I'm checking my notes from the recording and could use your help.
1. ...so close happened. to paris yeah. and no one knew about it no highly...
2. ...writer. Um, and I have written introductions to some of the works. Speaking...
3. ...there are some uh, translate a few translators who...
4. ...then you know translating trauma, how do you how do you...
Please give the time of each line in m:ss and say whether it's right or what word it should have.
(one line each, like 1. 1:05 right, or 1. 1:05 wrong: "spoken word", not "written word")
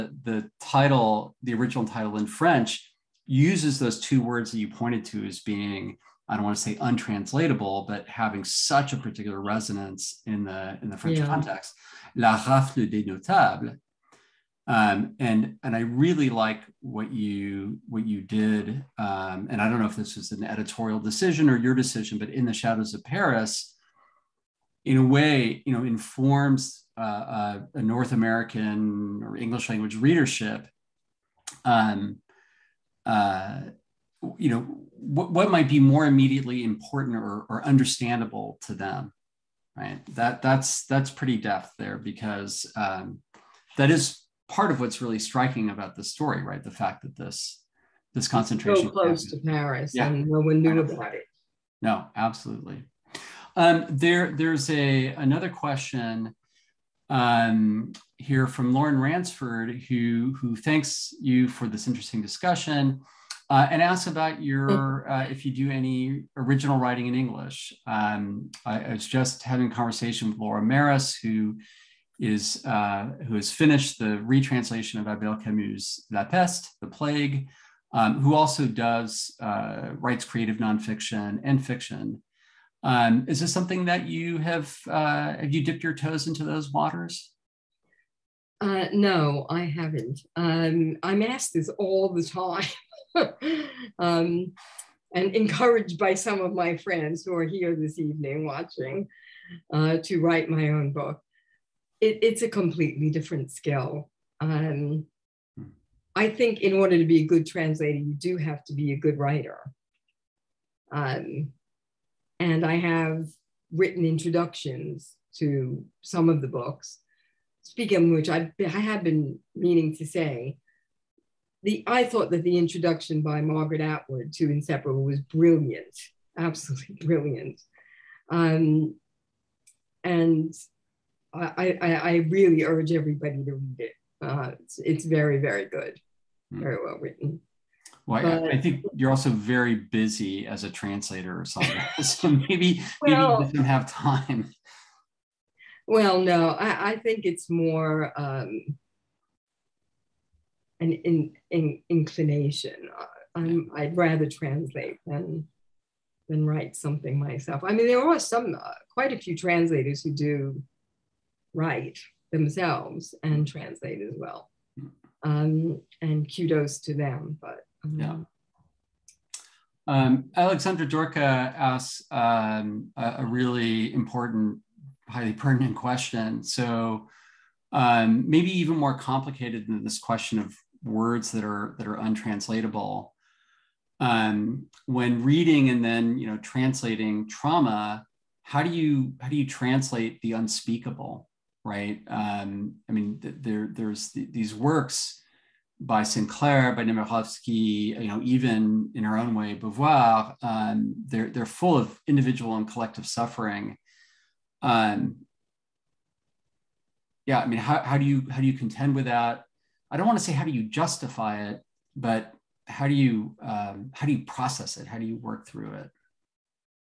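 1. 0:48 wrong: "absolutely", not "highly"
2. 1:49 wrong: "books", not "works"
3. 2:37 wrong: "quite", not "translate"
4. 3:05 right.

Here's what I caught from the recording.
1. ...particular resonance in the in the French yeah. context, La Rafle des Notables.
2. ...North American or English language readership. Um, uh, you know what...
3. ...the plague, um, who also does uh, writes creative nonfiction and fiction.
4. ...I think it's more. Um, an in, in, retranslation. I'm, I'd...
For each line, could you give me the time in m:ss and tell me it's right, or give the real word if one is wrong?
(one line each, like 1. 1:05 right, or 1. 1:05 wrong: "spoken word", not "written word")
1. 0:08 right
2. 0:27 right
3. 1:16 right
4. 2:26 wrong: "inclination", not "retranslation".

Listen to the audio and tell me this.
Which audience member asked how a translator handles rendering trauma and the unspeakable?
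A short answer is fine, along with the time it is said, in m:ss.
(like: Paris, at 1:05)
Alexandra Dorka, at 2:50.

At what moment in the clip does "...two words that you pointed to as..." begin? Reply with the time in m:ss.
0:03.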